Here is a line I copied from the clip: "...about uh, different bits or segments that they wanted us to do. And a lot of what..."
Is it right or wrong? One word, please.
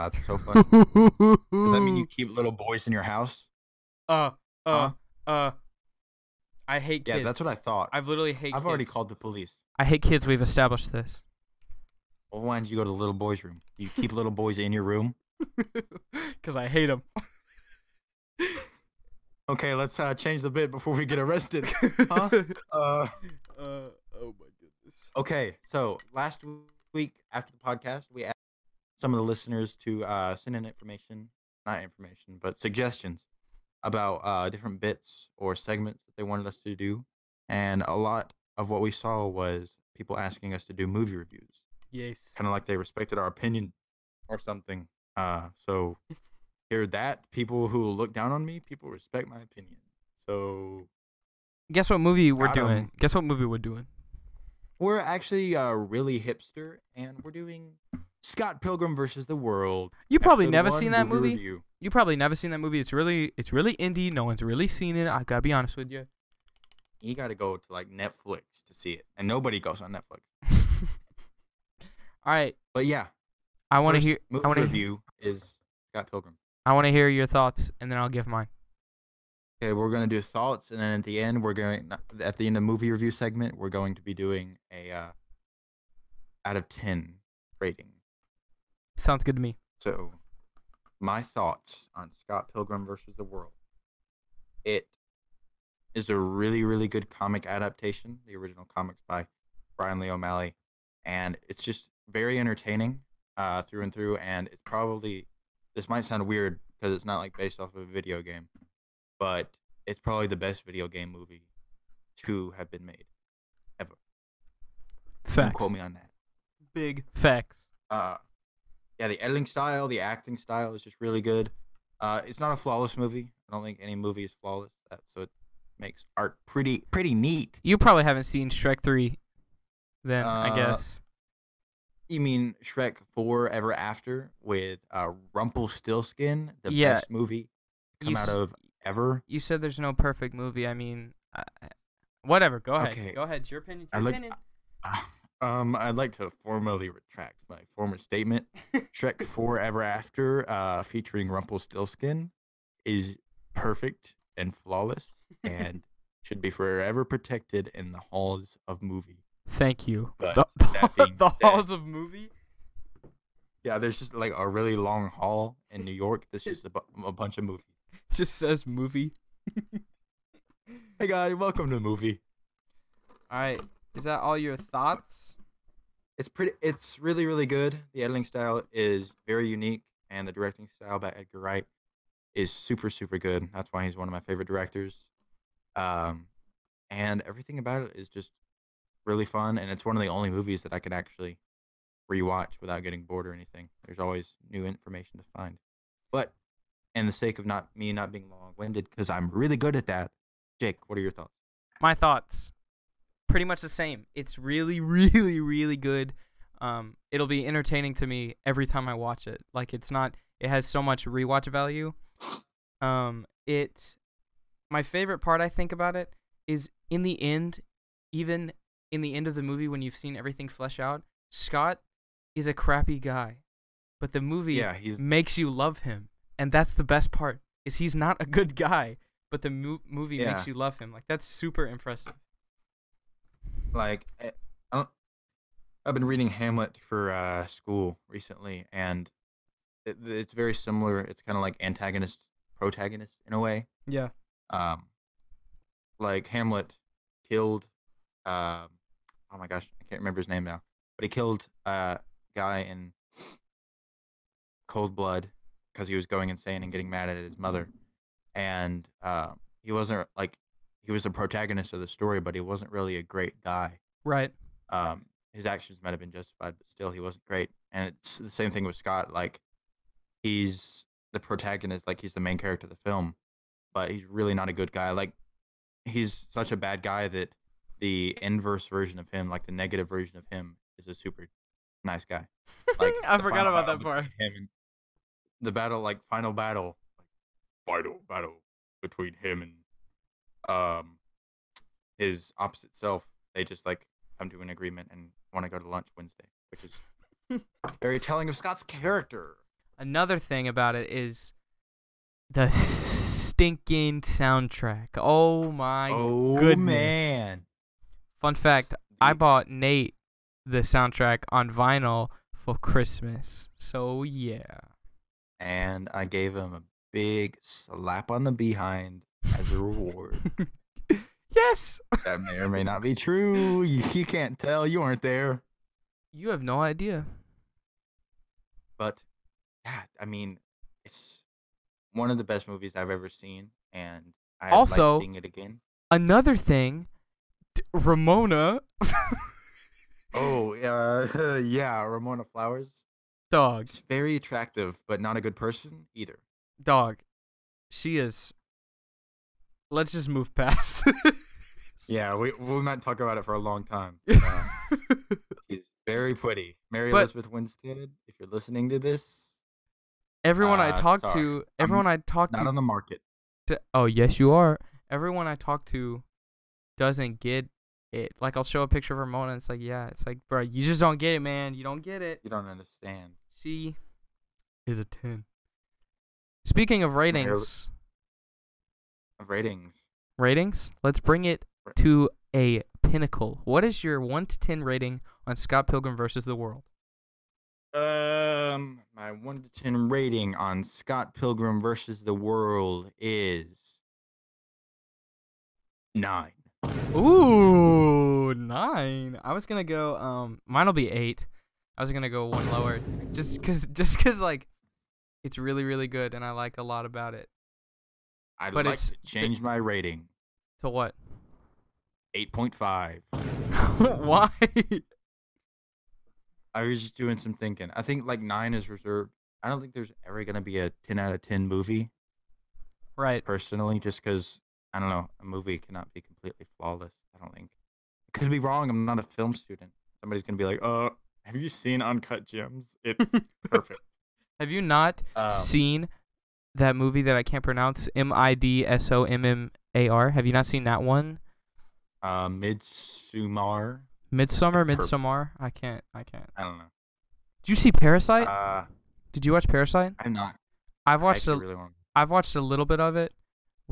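right.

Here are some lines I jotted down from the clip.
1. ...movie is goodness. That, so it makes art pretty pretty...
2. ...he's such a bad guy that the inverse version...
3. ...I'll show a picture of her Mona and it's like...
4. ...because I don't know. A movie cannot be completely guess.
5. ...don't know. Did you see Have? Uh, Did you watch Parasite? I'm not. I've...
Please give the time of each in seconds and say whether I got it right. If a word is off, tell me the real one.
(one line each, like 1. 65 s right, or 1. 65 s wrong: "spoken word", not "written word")
1. 123 s wrong: "flawless", not "goodness"
2. 275 s right
3. 368 s right
4. 424 s wrong: "flawless", not "guess"
5. 446 s wrong: "Parasite", not "Have".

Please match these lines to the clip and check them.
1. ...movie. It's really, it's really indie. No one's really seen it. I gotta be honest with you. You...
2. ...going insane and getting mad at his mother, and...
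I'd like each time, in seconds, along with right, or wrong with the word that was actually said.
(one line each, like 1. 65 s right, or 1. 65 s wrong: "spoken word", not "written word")
1. 62 s right
2. 256 s right.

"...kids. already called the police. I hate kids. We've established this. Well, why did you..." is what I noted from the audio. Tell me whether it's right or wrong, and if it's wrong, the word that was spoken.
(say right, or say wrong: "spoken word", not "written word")
right.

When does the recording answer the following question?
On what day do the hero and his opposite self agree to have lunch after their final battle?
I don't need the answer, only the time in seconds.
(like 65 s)
295 s.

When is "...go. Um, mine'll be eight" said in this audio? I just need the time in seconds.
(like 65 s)
399 s.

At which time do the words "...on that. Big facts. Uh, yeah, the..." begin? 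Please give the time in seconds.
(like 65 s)
115 s.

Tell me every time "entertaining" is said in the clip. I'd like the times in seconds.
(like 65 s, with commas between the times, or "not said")
102 s, 207 s.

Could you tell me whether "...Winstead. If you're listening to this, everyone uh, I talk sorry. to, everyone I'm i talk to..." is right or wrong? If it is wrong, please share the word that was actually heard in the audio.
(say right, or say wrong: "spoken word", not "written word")
right.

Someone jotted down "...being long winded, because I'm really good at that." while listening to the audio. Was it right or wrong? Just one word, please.
right.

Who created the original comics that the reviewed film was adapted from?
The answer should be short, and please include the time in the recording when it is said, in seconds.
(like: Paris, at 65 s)
Brian Lee O'Malley, at 99 s.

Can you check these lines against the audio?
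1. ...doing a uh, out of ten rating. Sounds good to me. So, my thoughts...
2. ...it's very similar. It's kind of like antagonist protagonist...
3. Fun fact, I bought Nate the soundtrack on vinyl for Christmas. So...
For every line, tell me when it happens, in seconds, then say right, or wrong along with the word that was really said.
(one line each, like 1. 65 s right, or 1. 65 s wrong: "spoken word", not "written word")
1. 84 s right
2. 240 s right
3. 308 s right.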